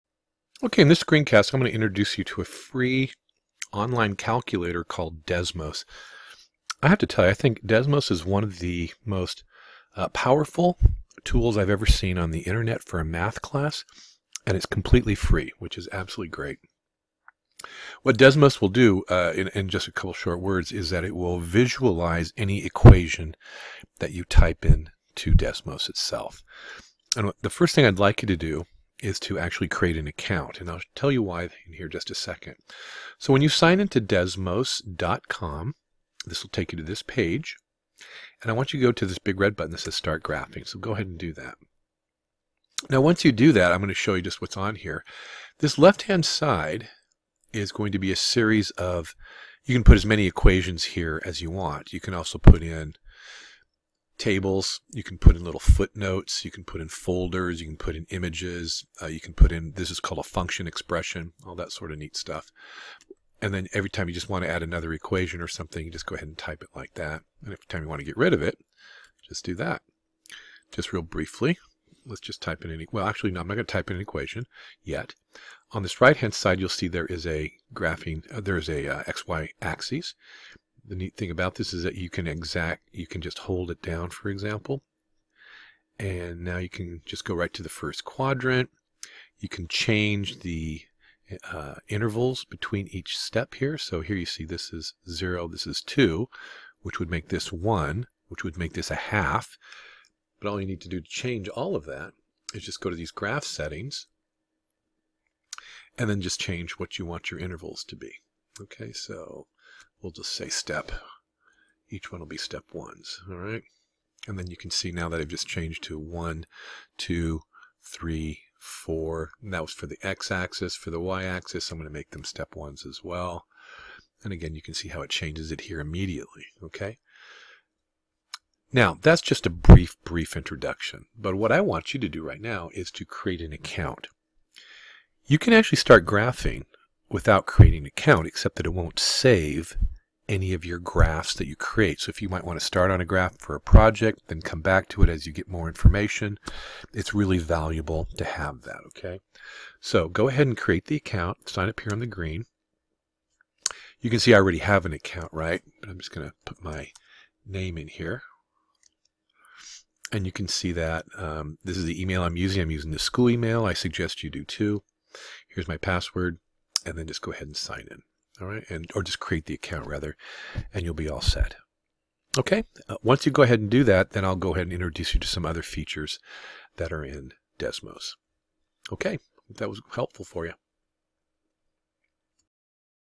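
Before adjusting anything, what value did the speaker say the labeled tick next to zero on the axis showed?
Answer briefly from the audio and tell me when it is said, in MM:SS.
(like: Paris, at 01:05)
2, at 01:35.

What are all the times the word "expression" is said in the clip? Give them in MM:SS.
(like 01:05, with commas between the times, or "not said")
01:00.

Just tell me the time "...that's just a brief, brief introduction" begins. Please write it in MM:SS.
02:09.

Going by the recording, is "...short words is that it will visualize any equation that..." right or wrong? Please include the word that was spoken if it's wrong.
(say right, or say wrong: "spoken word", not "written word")
right.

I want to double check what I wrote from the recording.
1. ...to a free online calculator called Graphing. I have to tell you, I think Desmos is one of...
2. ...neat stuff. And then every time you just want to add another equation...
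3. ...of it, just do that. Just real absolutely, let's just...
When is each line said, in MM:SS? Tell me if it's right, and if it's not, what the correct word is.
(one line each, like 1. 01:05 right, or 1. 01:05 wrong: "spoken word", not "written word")
1. 00:02 wrong: "Desmos", not "Graphing"
2. 01:01 right
3. 01:08 wrong: "briefly", not "absolutely".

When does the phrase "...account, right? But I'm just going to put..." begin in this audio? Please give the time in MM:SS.
02:34.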